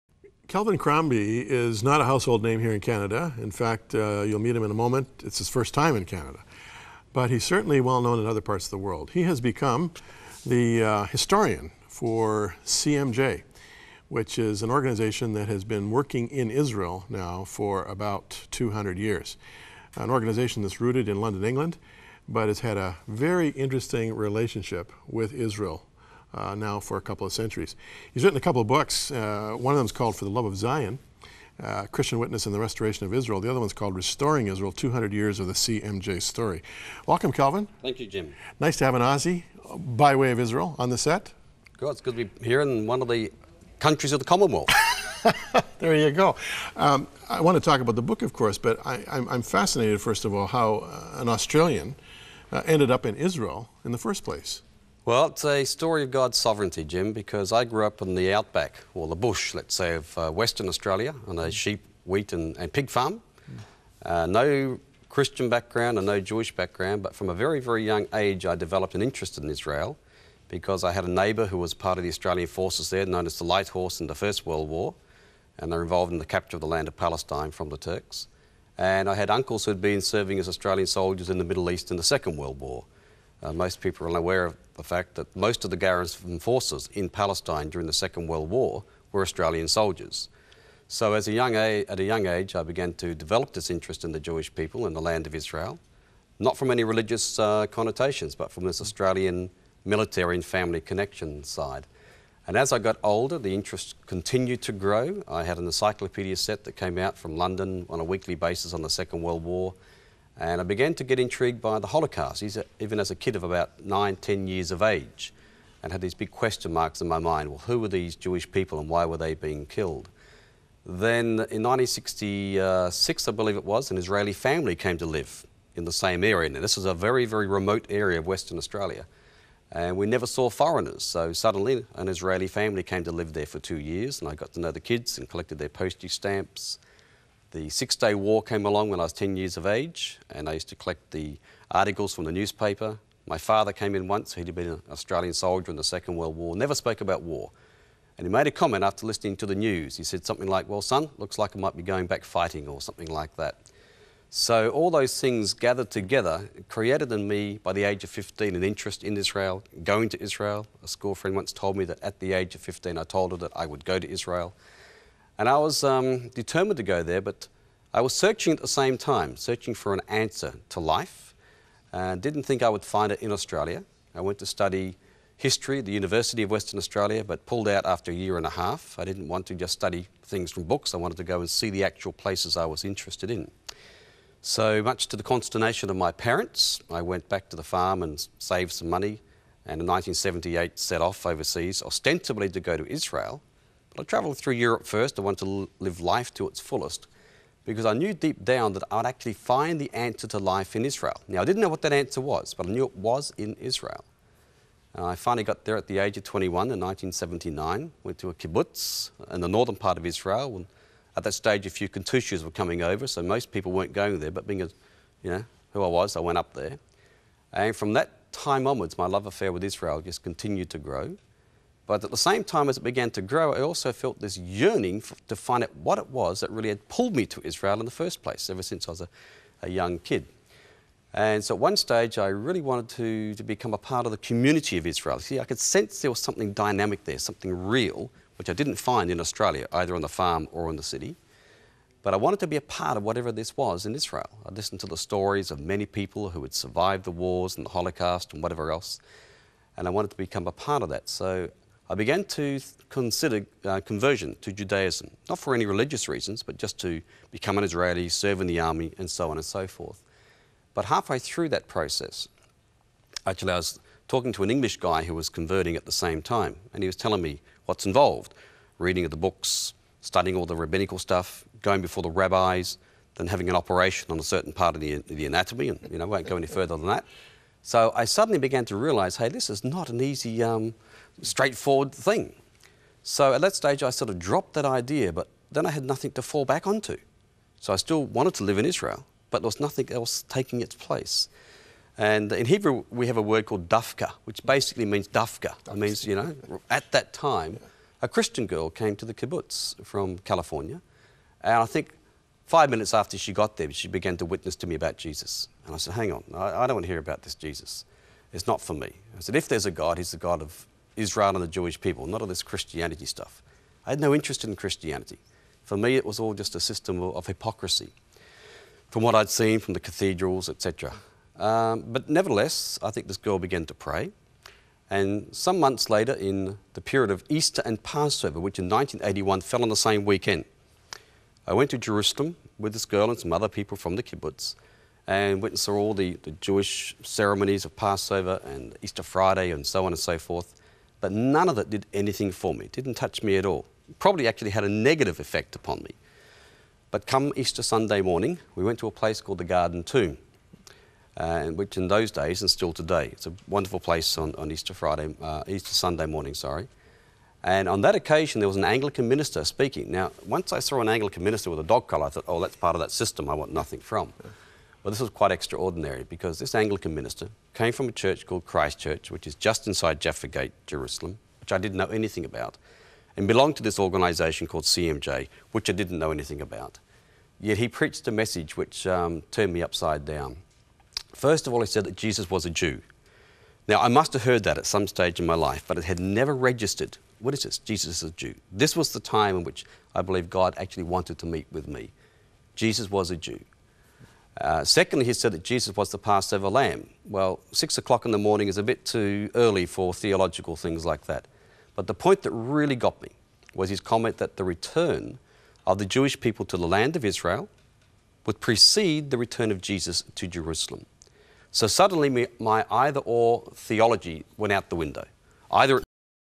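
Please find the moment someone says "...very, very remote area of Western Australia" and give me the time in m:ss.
2:06.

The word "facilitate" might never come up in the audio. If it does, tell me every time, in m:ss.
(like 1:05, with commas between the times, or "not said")
not said.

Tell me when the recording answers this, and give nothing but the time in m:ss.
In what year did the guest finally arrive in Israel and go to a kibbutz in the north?
3:26.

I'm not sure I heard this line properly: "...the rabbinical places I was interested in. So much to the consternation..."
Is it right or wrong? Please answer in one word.
wrong.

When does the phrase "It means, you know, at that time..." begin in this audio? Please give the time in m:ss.
4:55.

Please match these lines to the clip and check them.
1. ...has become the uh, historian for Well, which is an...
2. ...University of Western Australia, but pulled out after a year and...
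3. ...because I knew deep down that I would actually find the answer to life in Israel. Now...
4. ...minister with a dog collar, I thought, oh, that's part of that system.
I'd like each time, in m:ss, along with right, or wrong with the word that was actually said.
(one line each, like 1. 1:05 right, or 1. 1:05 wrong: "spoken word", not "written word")
1. 0:09 wrong: "CMJ", not "Well"
2. 2:55 right
3. 3:17 right
4. 6:01 right.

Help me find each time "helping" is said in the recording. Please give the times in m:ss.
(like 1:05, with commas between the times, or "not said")
not said.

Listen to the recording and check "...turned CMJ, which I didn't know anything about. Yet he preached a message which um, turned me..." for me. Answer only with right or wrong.
wrong.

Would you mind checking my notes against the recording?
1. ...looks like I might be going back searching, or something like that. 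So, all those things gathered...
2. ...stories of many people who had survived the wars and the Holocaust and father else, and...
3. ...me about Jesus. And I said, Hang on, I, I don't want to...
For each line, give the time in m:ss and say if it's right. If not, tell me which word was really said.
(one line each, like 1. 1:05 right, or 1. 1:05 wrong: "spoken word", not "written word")
1. 2:31 wrong: "fighting", not "searching"
2. 4:04 wrong: "whatever", not "father"
3. 5:04 right.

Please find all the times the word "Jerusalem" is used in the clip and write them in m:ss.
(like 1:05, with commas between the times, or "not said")
5:31, 6:10, 6:50.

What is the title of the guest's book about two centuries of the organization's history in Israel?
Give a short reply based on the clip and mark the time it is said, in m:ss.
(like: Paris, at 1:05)
Restoring Israel, 200 Years of the CMJ Story, at 0:33.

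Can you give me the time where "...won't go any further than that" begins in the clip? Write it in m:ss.
4:36.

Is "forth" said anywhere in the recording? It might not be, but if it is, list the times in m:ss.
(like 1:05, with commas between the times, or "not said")
4:19, 5:40.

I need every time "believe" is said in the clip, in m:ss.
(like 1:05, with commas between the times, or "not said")
2:03, 6:30.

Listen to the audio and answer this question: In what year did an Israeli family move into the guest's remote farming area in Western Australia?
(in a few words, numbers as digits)
1966.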